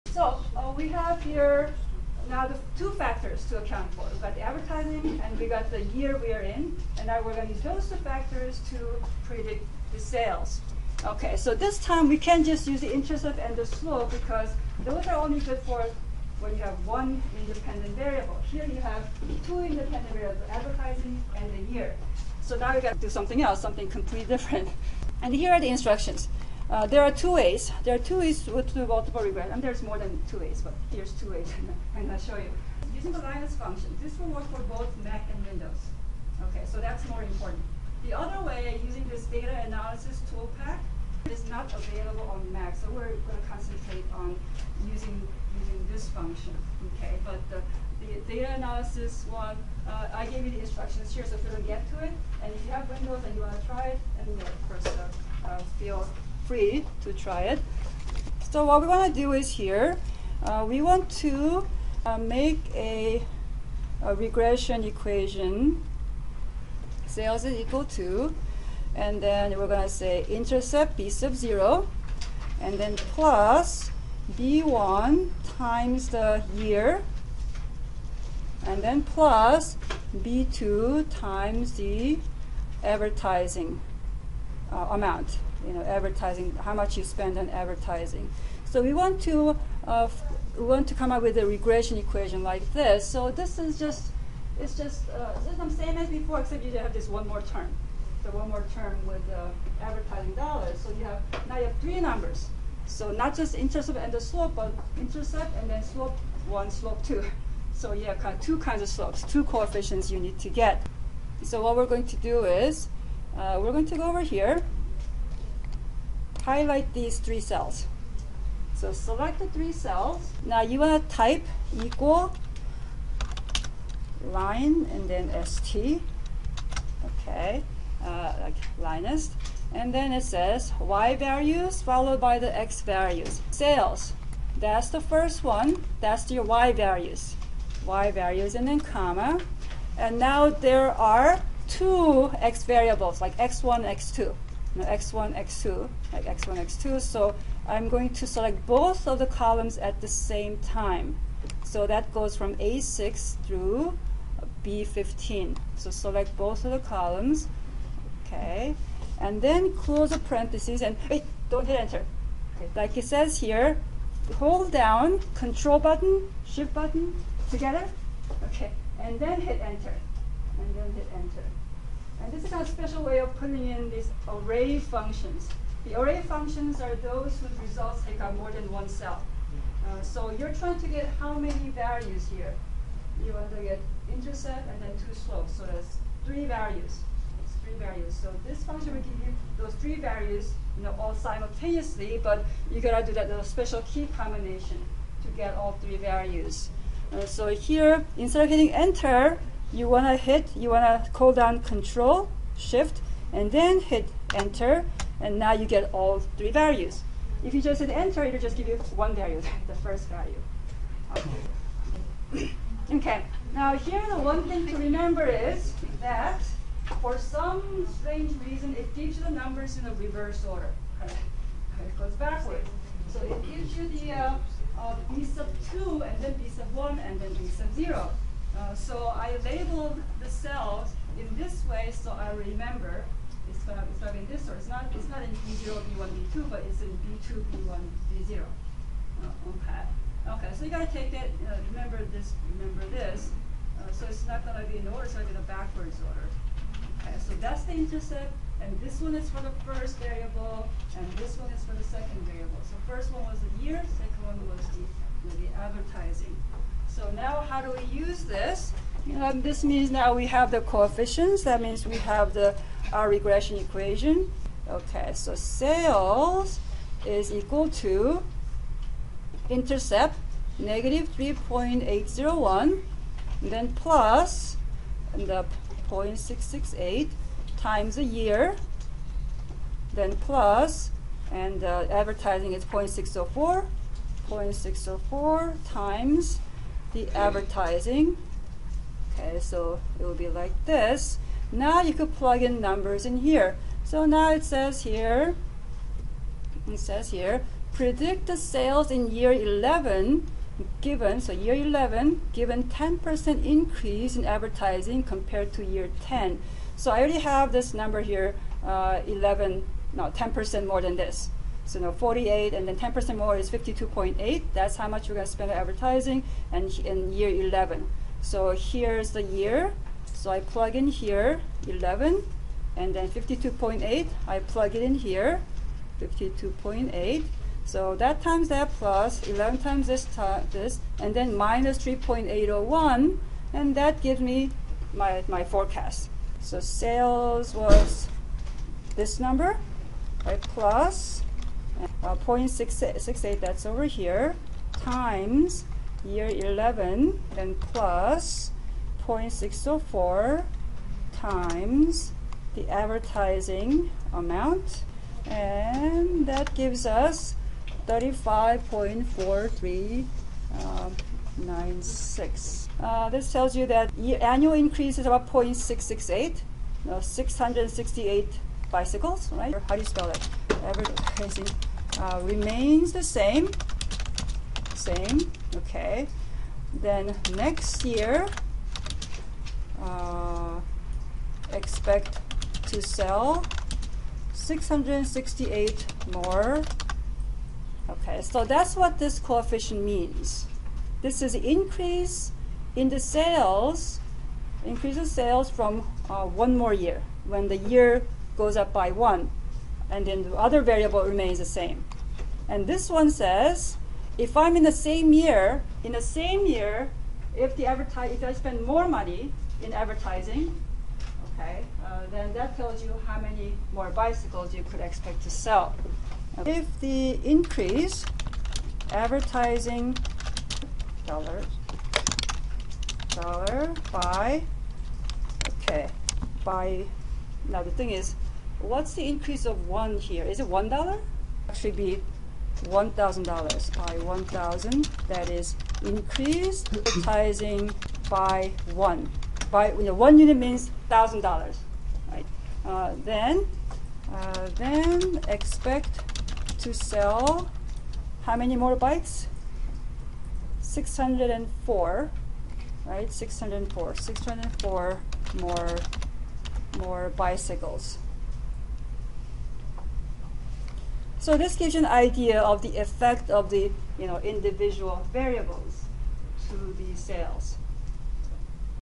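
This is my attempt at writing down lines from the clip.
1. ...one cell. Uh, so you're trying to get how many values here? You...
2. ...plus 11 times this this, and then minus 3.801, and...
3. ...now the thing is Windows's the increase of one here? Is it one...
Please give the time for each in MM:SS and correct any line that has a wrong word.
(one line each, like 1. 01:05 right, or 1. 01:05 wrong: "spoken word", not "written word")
1. 02:58 right
2. 05:28 right
3. 07:07 wrong: "What", not "Windows".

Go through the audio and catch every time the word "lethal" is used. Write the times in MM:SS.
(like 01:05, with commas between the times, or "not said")
not said.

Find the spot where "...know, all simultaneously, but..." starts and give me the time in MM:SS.
03:10.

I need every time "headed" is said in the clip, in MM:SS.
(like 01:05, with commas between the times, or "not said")
not said.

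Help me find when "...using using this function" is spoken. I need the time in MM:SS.
00:44.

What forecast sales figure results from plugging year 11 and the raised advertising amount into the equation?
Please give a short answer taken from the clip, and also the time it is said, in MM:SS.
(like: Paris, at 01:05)
35.4396, at 05:57.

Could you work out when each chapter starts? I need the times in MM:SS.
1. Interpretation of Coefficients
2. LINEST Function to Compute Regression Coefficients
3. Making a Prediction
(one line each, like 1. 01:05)
1. 06:03
2. 01:53
3. 04:53.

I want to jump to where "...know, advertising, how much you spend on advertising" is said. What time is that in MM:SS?
01:25.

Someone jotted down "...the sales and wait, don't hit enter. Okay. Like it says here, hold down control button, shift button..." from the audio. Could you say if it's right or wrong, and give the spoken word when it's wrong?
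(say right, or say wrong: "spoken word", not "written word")
wrong: "parentheses", not "sales".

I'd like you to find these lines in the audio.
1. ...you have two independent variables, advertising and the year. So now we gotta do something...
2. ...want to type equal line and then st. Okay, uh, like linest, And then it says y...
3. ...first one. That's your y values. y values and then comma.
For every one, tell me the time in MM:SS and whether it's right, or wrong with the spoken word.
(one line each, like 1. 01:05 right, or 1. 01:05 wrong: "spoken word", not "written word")
1. 00:18 right
2. 02:00 right
3. 02:15 right.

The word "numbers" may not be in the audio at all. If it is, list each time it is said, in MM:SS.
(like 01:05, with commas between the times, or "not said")
01:41, 03:39, 04:52, 05:07, 05:39.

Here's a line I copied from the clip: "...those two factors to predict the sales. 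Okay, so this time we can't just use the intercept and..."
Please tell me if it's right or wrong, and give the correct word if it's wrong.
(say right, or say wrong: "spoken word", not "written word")
right.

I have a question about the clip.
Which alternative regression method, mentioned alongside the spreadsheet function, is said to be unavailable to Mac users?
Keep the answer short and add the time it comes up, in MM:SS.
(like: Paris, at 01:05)
data analysis tool pack, at 00:39.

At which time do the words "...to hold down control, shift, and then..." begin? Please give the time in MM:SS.
03:21.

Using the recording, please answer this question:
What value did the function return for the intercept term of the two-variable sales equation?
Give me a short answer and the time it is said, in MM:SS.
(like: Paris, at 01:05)
-3.801, at 04:30.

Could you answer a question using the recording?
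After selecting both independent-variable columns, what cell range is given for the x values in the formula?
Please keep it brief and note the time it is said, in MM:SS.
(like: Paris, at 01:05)
A6 through B15, at 02:32.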